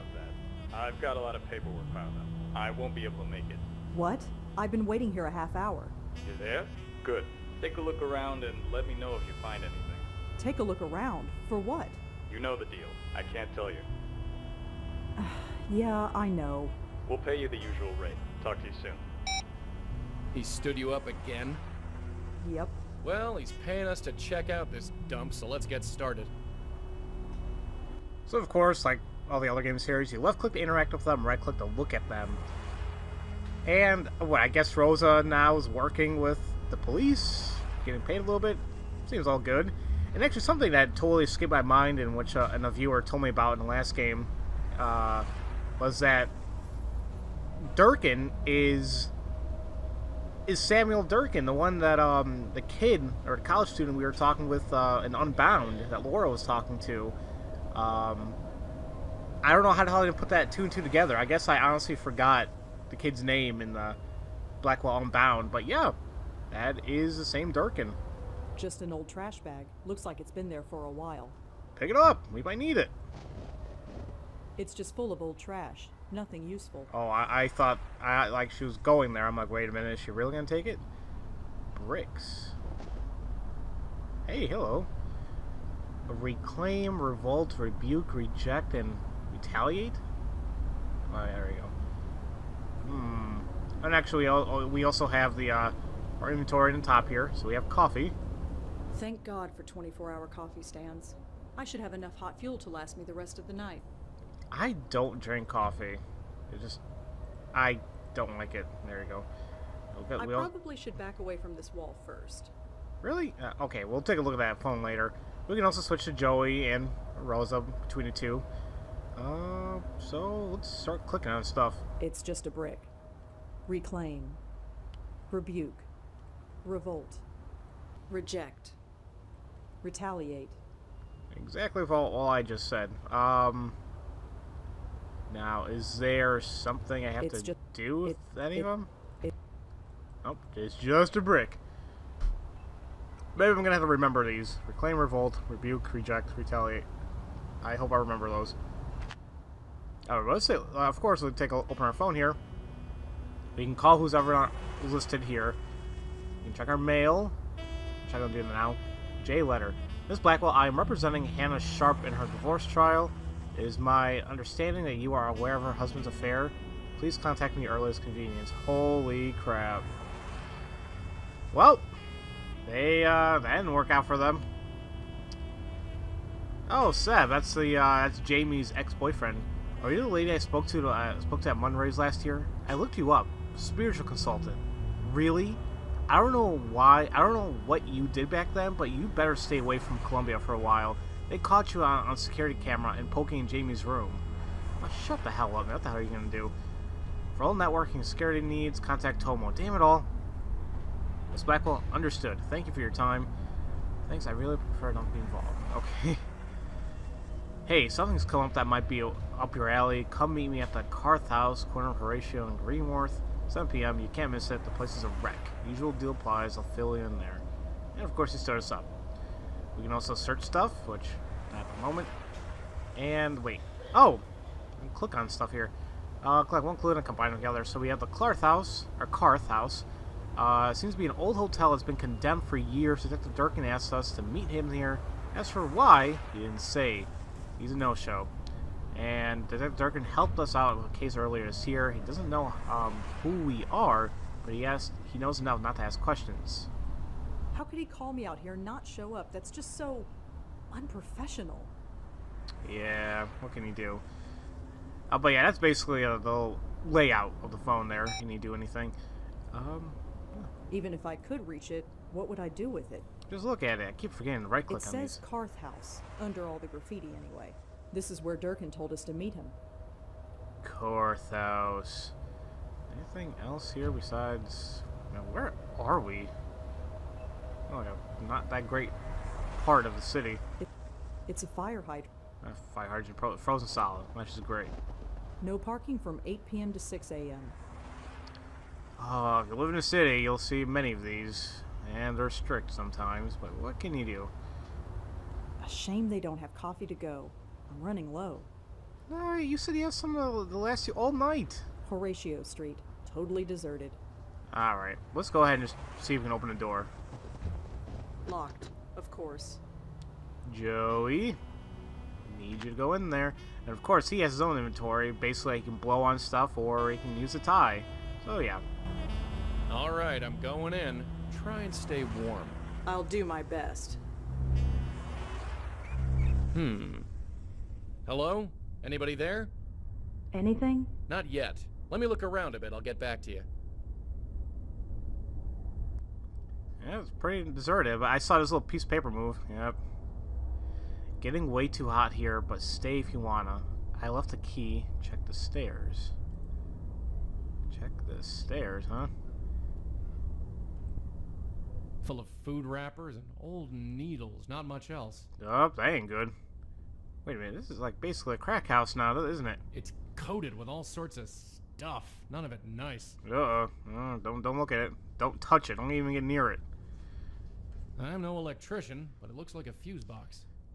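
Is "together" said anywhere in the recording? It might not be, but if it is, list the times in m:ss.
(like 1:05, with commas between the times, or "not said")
1:00, 3:47.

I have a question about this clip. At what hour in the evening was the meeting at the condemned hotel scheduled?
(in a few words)
7 p.m.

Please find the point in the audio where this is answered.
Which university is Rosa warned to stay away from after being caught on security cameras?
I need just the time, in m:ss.
3:10.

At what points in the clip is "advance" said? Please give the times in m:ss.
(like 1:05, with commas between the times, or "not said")
not said.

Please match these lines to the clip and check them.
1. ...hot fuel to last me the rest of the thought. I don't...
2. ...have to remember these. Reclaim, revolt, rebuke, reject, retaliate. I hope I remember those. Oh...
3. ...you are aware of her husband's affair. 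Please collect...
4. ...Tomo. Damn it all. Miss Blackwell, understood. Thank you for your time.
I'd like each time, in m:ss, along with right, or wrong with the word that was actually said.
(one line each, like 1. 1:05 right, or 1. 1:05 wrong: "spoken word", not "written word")
1. 1:42 wrong: "night", not "thought"
2. 2:23 right
3. 2:44 wrong: "contact", not "collect"
4. 3:19 right.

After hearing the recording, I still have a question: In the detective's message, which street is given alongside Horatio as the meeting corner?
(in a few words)
Greenwich.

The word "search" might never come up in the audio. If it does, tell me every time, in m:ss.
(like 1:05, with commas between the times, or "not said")
3:40.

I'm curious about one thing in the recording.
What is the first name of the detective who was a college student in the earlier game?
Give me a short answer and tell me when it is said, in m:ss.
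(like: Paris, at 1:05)
Samuel, at 0:50.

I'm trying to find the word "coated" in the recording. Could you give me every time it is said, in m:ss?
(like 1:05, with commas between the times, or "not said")
6:00.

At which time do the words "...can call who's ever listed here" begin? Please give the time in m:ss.
2:33.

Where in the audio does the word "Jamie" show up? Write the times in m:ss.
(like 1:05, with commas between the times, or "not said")
2:58, 3:13.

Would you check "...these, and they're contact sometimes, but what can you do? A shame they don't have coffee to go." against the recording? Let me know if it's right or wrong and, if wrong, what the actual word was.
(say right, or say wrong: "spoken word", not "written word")
wrong: "strict", not "contact".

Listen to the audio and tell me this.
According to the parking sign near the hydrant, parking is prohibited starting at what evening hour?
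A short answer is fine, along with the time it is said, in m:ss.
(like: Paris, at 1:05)
8 p.m., at 4:46.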